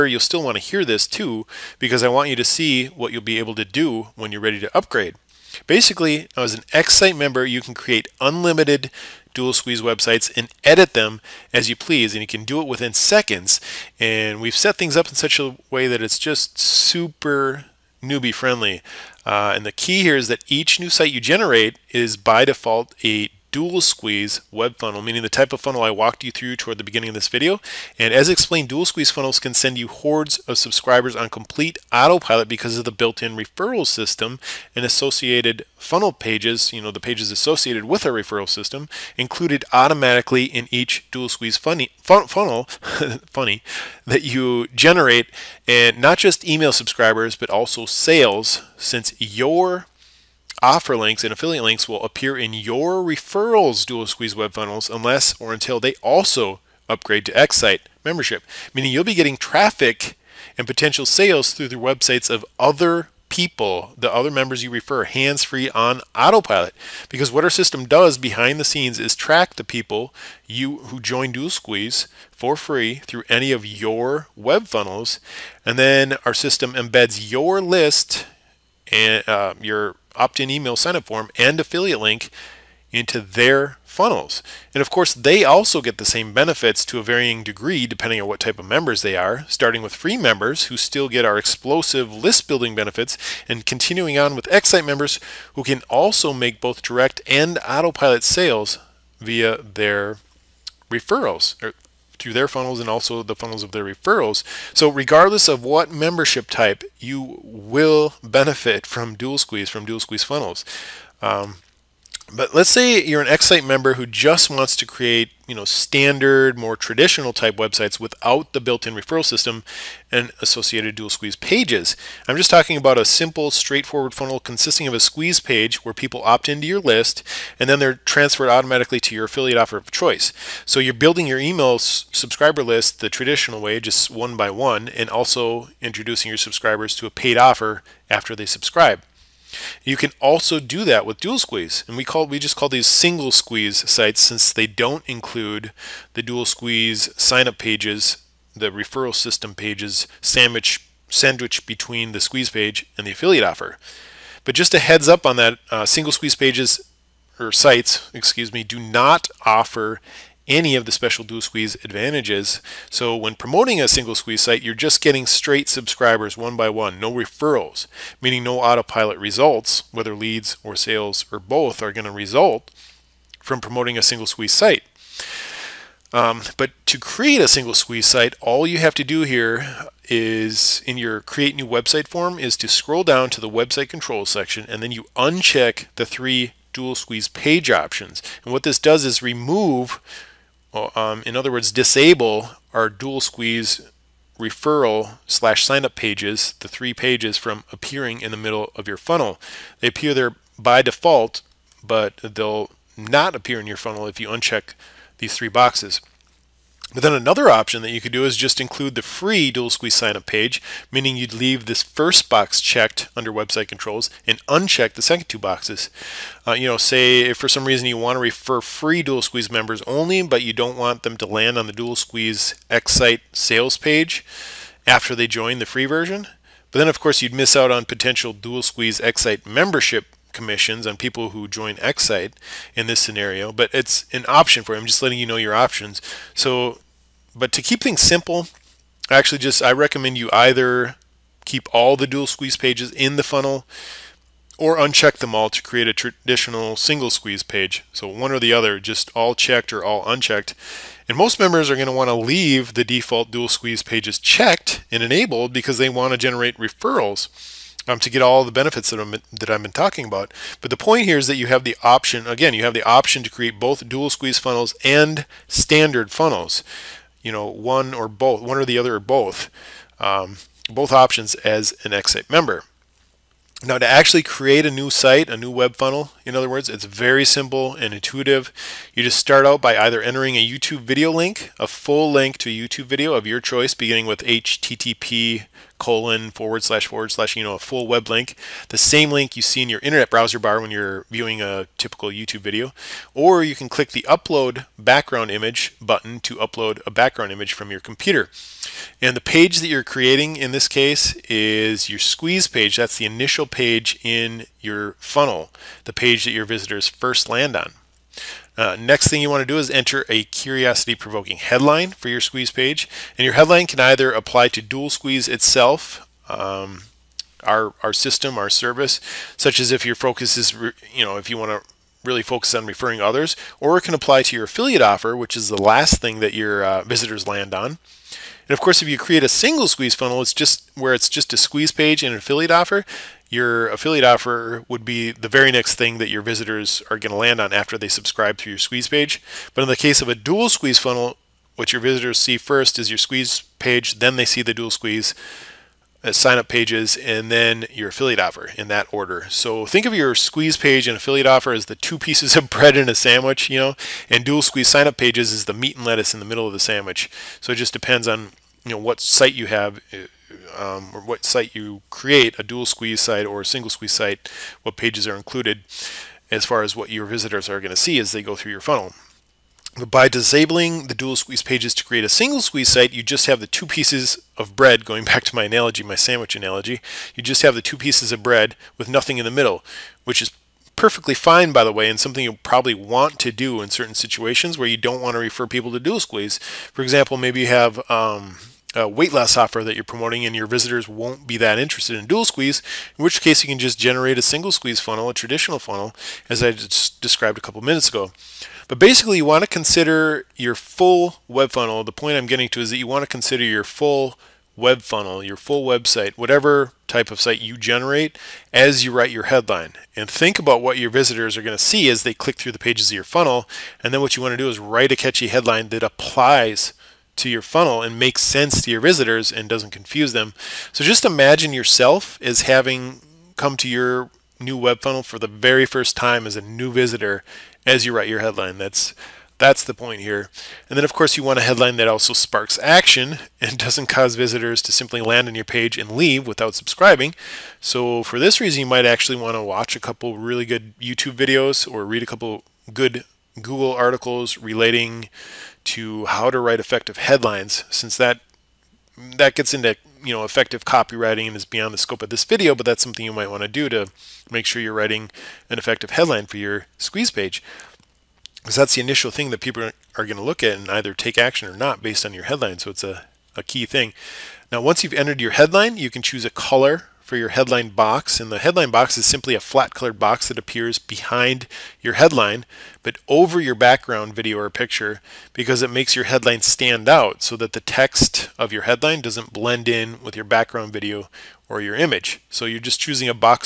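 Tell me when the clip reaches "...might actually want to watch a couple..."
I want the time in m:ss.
7:18.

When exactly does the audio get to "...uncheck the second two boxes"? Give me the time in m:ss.
3:34.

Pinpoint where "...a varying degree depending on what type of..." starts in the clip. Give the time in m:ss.
1:26.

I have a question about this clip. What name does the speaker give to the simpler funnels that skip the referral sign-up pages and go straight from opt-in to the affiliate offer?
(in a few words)
Single squeeze sites.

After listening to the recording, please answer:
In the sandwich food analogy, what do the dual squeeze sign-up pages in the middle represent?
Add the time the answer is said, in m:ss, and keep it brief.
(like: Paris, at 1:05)
Meat and lettuce, at 5:55.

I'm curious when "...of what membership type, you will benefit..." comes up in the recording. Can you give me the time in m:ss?
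1:45.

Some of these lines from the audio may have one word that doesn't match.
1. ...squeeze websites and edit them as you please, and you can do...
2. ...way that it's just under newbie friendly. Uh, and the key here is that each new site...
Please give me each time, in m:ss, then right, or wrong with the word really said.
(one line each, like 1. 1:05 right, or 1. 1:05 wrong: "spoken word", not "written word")
1. 0:09 right
2. 0:15 wrong: "super", not "under".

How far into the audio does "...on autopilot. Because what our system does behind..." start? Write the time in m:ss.
1:05.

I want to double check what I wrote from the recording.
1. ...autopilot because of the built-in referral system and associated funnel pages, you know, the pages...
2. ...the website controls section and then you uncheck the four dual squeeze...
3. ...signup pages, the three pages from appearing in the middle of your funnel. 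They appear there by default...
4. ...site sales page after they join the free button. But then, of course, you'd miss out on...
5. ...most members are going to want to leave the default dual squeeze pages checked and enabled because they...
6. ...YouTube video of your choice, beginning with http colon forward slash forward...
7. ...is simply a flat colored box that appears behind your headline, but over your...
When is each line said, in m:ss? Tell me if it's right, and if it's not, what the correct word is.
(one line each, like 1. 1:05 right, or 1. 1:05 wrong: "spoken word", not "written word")
1. 0:31 right
2. 3:03 wrong: "three", not "four"
3. 3:15 right
4. 3:42 wrong: "version", not "button"
5. 4:11 right
6. 4:42 right
7. 7:48 right.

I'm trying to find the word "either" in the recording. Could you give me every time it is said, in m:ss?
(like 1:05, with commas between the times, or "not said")
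4:00, 4:39, 5:13, 7:40.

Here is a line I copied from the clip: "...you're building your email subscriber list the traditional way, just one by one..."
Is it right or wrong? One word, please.
right.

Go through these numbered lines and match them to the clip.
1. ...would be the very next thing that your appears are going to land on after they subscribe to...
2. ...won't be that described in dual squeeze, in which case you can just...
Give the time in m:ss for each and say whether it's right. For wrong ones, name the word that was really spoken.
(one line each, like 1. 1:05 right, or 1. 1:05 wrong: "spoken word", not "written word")
1. 5:34 wrong: "visitors", not "appears"
2. 6:30 wrong: "interested", not "described".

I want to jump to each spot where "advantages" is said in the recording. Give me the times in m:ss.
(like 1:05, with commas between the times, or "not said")
2:41.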